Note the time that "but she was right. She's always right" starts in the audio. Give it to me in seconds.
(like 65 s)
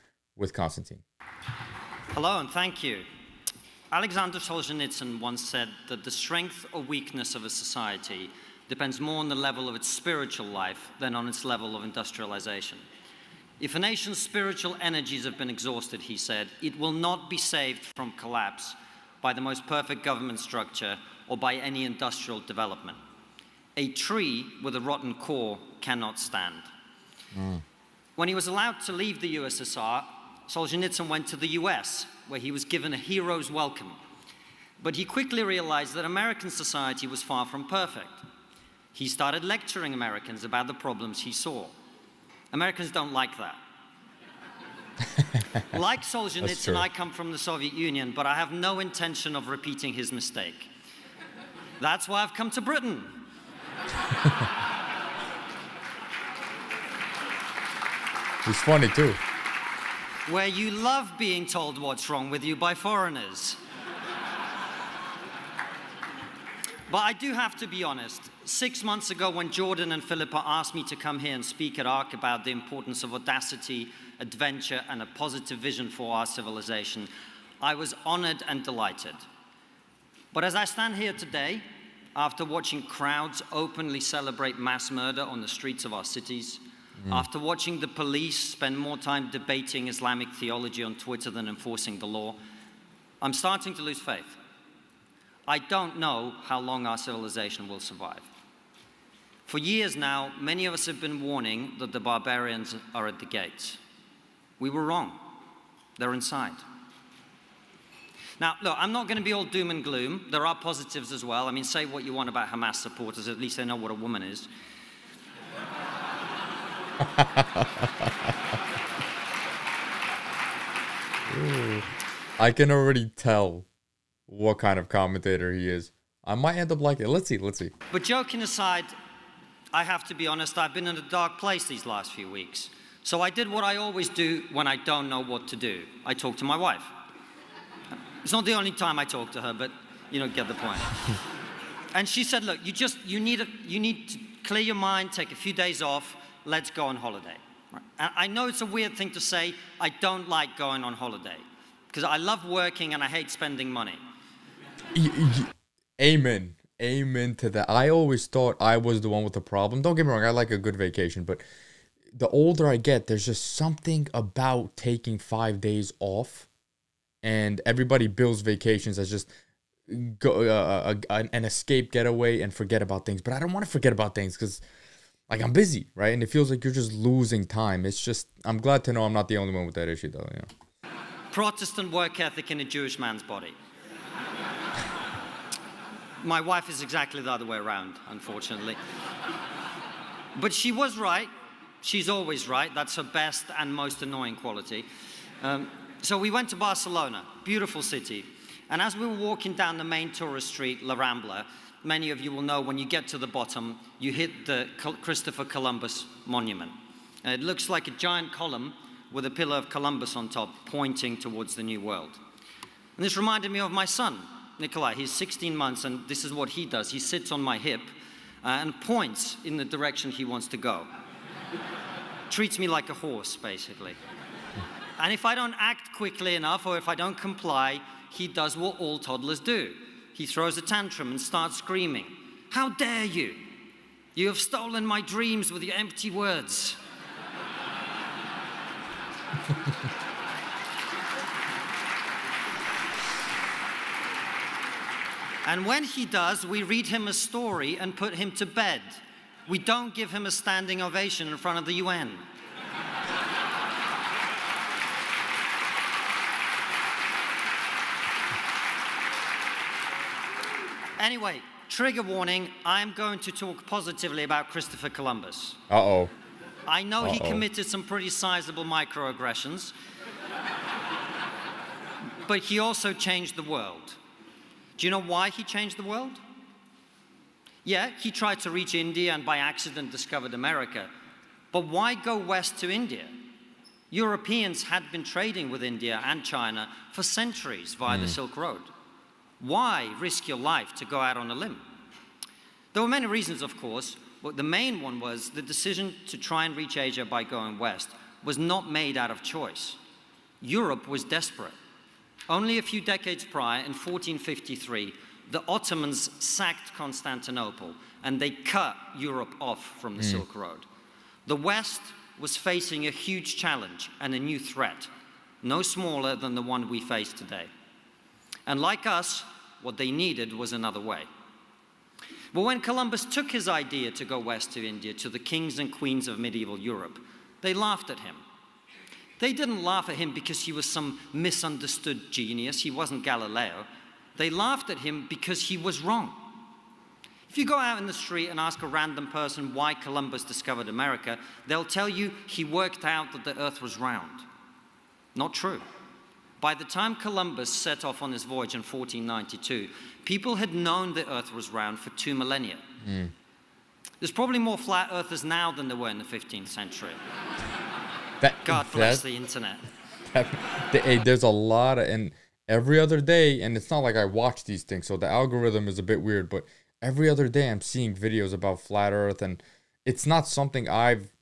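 190 s.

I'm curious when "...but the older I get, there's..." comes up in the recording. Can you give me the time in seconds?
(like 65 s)
161 s.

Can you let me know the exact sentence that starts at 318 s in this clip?
And like us, what they needed was another way.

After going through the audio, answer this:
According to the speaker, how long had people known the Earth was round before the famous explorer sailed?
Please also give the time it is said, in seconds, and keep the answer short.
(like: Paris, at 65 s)
2 millennia, at 351 s.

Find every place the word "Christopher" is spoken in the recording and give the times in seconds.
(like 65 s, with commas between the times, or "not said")
204 s, 264 s.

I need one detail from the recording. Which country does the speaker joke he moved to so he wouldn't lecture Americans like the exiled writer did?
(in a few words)
Britain.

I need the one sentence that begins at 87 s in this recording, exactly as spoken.
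After watching the police spend more time debating Islamic theology on Twitter than enforcing the law, I'm starting to lose faith.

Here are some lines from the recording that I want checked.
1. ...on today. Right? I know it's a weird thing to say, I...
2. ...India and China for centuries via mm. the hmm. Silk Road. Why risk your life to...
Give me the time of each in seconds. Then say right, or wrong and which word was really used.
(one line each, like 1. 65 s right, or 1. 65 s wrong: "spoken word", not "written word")
1. 146 s wrong: "holiday", not "today"
2. 285 s right.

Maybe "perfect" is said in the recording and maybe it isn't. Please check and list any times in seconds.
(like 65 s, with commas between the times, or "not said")
19 s, 37 s.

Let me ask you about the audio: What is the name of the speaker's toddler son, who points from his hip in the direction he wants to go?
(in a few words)
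Nikolai.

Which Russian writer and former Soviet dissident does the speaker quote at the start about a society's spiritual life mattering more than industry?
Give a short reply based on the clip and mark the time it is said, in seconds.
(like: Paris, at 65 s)
Alexander Solzhenitsyn, at 3 s.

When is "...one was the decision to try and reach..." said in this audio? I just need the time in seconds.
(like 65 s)
294 s.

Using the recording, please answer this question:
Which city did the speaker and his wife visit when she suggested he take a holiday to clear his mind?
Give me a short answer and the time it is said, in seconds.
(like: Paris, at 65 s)
Barcelona, at 196 s.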